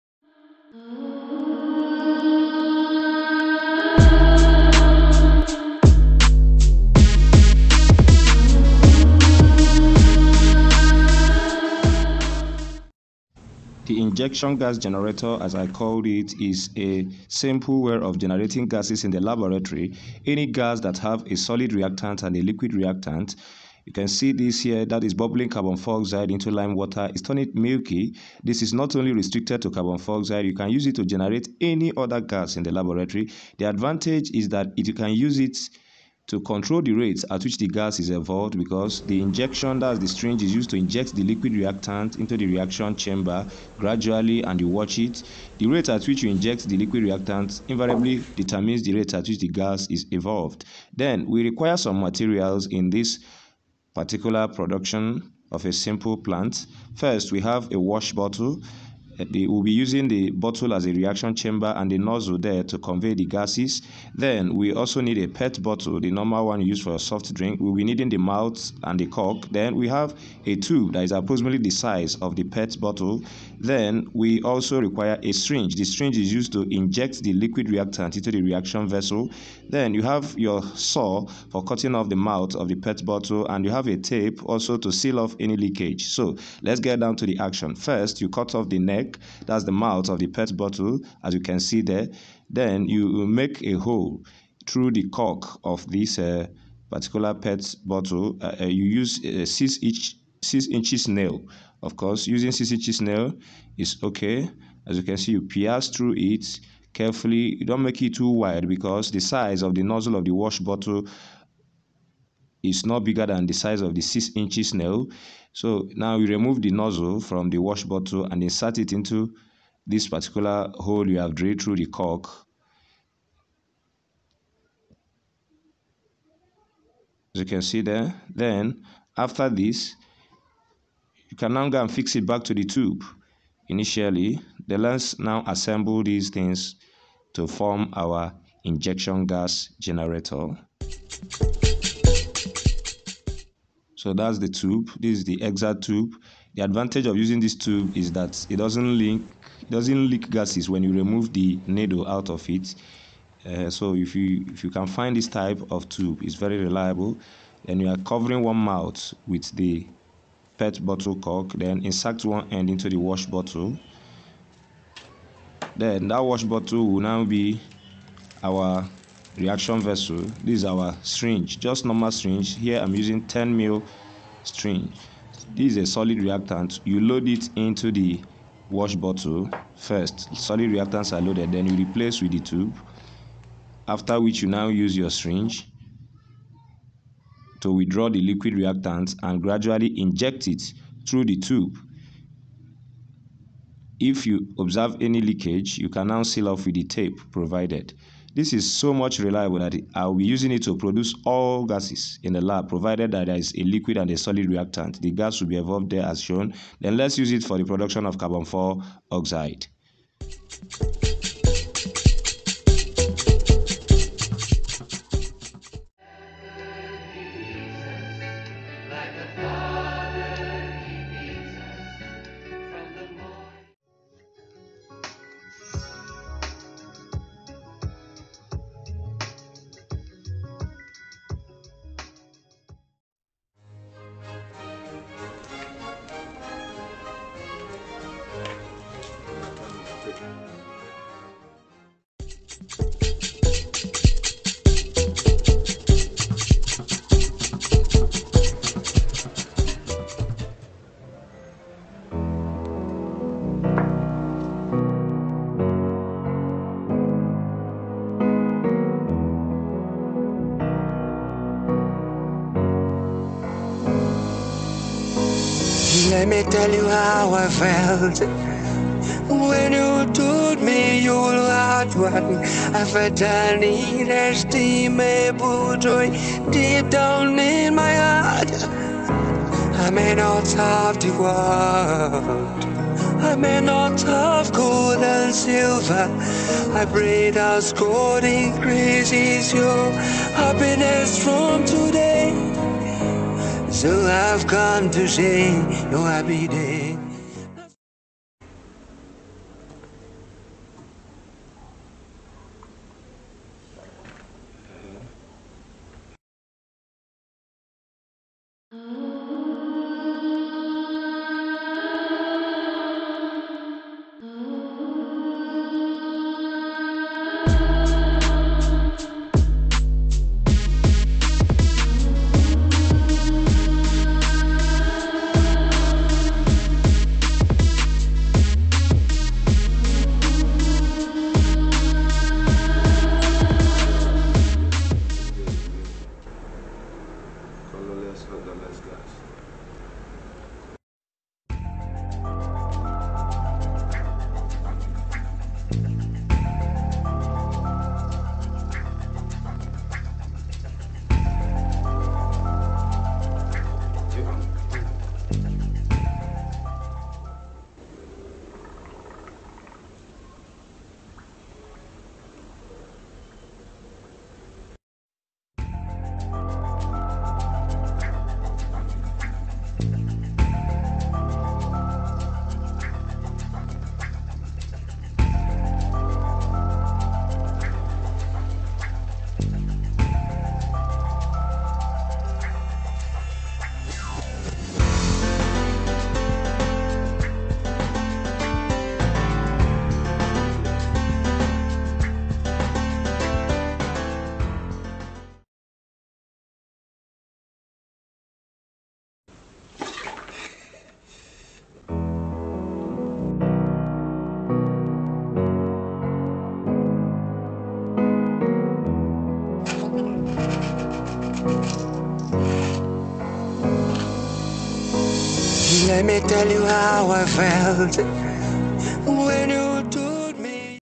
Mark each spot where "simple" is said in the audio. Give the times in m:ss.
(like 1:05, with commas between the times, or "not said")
0:17, 0:55.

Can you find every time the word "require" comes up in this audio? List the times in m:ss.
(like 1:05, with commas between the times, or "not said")
0:51, 1:14.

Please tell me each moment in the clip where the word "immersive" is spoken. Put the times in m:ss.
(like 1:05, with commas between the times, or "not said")
not said.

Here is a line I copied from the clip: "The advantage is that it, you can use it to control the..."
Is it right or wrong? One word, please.
right.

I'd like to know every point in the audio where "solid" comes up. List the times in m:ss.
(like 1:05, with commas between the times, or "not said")
0:21, 2:55, 3:00, 3:24.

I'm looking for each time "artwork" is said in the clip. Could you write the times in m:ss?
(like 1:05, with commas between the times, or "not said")
not said.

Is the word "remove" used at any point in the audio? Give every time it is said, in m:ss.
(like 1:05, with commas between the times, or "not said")
1:56, 2:30.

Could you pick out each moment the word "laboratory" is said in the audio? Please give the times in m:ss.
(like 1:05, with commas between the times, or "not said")
0:19, 0:32.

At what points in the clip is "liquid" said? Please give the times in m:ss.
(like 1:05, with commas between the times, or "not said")
0:22, 0:41, 0:46, 1:17, 3:08, 3:23.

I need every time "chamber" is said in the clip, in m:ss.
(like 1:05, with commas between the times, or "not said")
0:42, 1:01.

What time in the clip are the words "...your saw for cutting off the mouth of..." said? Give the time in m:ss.
1:20.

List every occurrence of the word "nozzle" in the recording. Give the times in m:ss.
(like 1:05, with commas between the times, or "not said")
1:01, 1:49, 1:56.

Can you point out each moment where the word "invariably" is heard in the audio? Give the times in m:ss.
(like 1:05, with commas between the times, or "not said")
0:47.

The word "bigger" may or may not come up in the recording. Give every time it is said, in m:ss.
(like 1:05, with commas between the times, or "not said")
1:53.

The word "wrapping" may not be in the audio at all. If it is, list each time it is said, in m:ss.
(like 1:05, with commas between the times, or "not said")
not said.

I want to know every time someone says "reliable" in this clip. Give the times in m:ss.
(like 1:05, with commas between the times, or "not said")
2:36, 3:19.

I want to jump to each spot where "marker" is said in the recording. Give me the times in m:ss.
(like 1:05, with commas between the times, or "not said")
not said.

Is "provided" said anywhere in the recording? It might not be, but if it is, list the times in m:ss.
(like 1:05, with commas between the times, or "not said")
3:17, 3:22.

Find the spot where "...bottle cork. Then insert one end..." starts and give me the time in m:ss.
2:40.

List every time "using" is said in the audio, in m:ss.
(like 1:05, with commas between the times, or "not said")
0:59, 1:42, 2:27, 2:52, 3:20.